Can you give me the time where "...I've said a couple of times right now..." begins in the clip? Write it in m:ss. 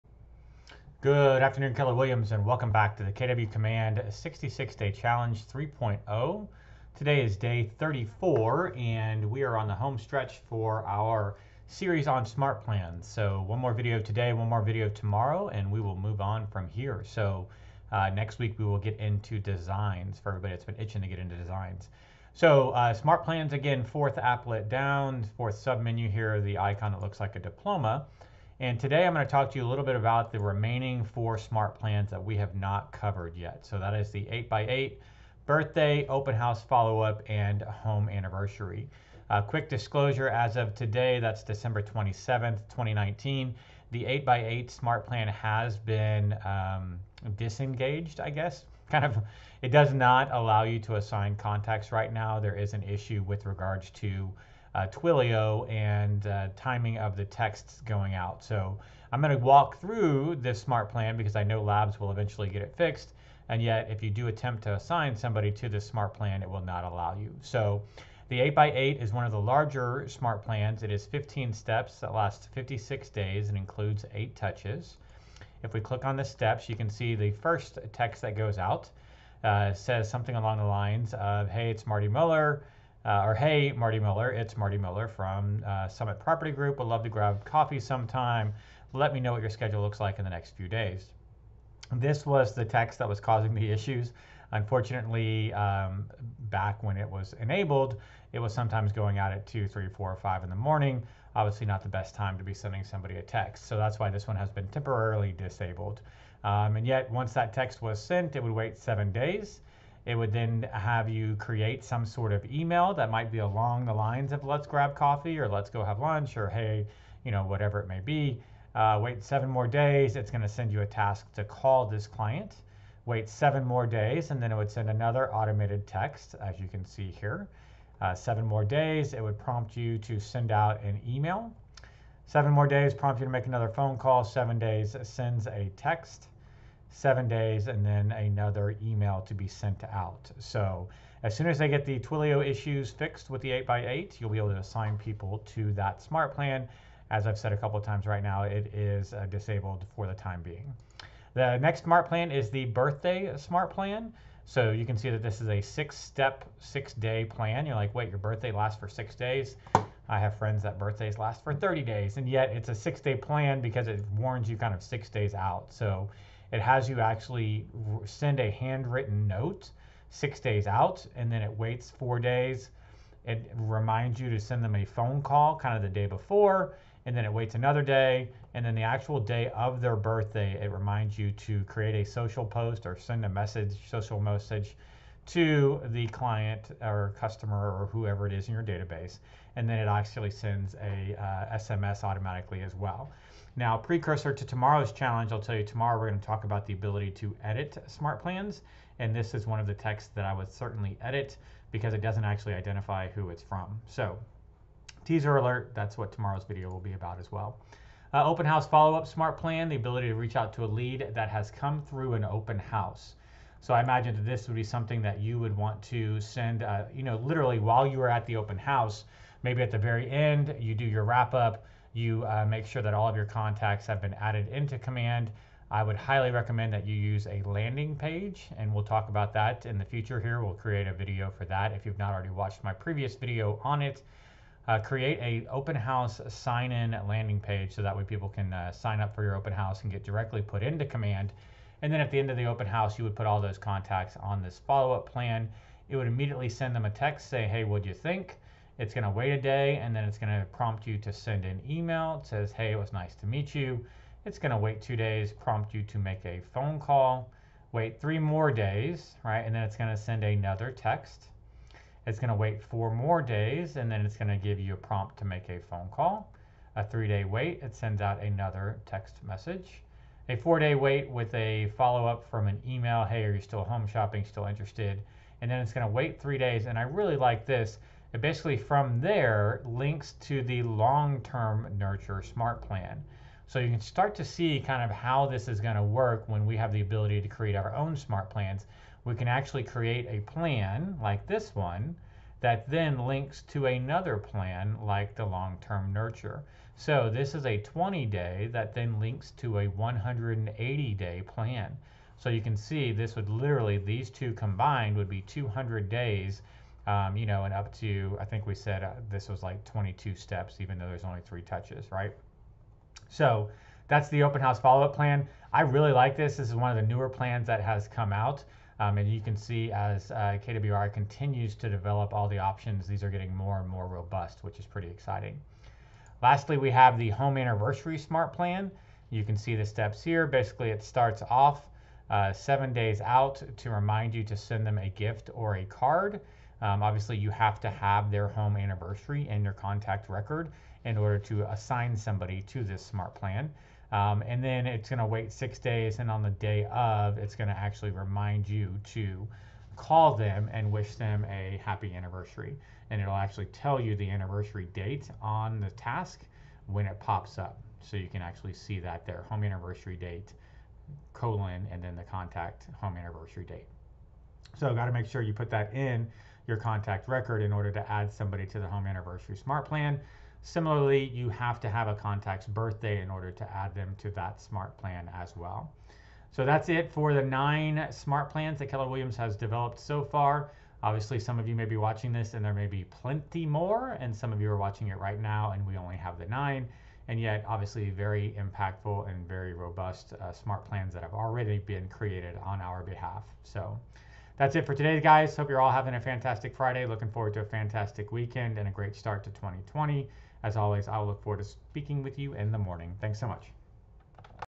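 2:27.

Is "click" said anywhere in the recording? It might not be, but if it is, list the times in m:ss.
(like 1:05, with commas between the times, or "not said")
1:15.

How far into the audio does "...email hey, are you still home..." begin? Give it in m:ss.
4:32.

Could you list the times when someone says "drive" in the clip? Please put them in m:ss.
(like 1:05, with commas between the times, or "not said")
not said.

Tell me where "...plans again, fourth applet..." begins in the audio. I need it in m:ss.
0:23.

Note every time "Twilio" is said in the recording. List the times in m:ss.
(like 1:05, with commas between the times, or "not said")
0:54, 2:21.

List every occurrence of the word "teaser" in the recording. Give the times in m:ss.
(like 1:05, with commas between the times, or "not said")
3:25.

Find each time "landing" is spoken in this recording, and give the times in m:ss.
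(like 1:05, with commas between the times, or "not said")
3:47, 3:57.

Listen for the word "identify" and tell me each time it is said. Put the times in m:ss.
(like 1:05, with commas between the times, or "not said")
3:22.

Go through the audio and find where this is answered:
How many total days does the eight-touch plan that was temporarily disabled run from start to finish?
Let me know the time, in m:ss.
1:12.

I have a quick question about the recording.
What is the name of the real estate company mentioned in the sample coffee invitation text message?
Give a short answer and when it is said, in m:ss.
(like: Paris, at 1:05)
Summit Property Group, at 1:25.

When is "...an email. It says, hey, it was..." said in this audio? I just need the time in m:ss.
4:11.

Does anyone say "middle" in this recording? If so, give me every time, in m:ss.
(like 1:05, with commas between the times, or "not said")
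not said.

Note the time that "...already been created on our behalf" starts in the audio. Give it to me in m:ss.
6:31.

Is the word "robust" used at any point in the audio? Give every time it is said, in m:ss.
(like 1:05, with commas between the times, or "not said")
5:23, 6:29.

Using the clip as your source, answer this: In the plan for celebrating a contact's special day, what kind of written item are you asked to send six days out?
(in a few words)
A handwritten note.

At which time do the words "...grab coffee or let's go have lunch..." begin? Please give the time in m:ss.
1:54.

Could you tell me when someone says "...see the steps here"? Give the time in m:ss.
5:29.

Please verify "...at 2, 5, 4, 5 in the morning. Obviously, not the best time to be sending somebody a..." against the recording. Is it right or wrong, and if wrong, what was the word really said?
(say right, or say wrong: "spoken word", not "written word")
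wrong: "3", not "5".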